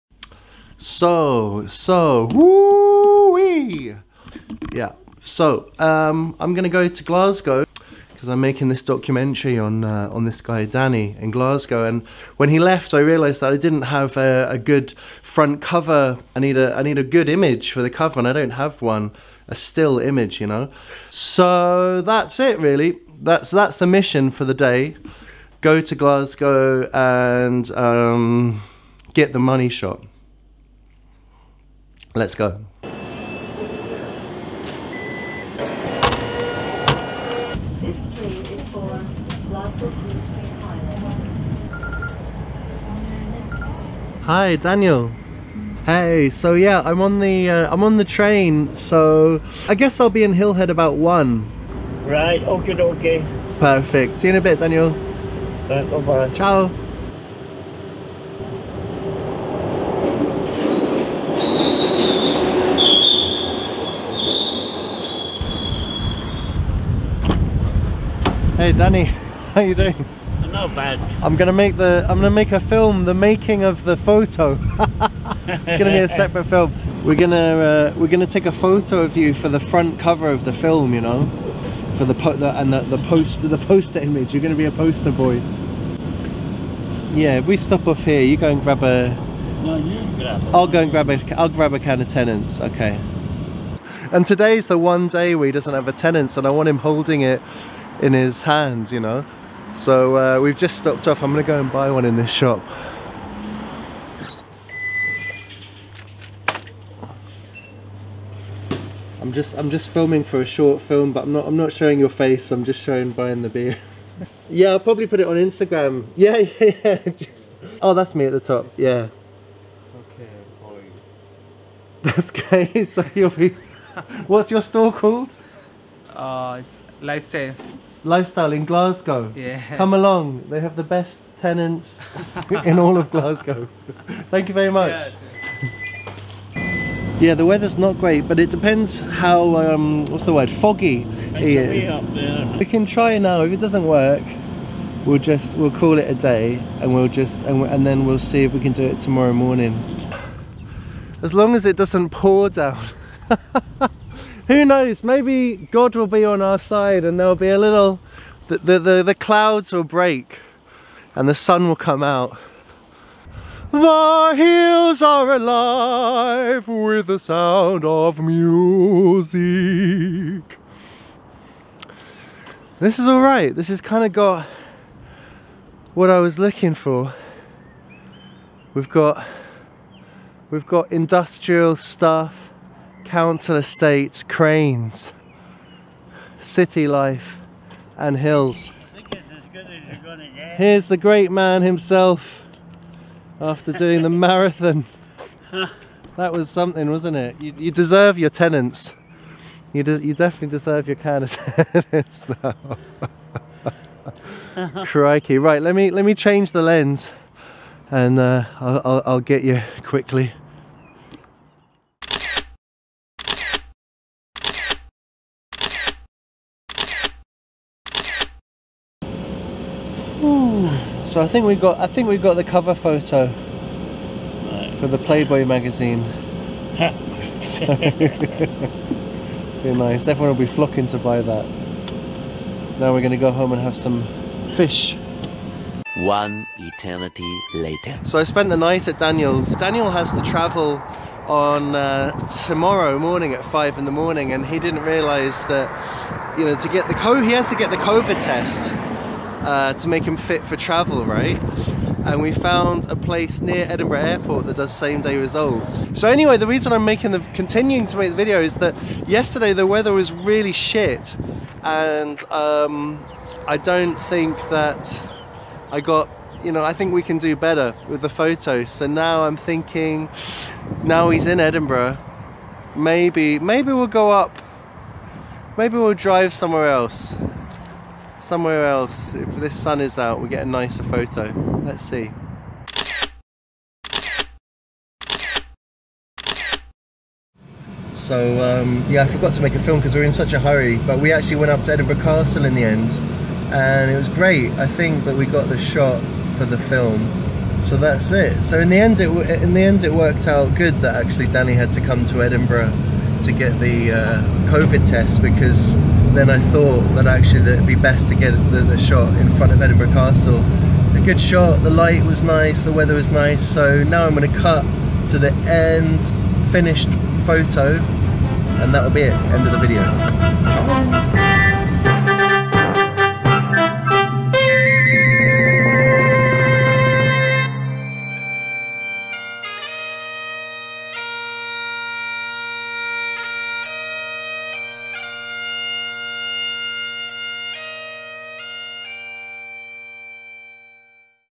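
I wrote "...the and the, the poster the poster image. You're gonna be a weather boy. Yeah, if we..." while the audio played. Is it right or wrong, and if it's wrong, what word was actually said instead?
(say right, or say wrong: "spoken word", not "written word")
wrong: "poster", not "weather".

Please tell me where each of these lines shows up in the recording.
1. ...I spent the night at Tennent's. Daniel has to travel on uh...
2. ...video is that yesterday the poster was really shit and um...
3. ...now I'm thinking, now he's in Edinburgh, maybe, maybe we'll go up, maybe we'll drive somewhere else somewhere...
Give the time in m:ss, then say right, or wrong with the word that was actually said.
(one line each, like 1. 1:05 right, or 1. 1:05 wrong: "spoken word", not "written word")
1. 3:58 wrong: "Daniel", not "Tennent"
2. 4:18 wrong: "weather", not "poster"
3. 4:28 right.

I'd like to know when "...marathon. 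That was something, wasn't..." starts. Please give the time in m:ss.
3:14.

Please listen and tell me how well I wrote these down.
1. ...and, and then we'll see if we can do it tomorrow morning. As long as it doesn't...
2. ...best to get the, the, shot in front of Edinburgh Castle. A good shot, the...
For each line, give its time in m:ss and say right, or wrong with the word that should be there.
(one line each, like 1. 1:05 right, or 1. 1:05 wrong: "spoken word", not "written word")
1. 2:27 right
2. 5:07 right.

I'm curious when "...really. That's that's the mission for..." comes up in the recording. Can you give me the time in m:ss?
0:22.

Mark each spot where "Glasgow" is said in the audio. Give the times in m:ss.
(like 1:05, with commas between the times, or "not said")
0:07, 0:11, 0:25, 2:08, 2:13.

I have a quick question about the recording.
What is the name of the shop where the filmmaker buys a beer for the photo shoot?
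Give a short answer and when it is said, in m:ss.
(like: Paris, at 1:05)
Lifestyle, at 2:06.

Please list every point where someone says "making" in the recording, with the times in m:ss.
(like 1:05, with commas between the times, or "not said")
0:08, 1:13, 4:16.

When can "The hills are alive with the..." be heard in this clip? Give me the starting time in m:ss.
2:43.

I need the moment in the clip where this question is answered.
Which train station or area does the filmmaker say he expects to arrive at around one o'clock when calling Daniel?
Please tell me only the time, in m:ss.
0:50.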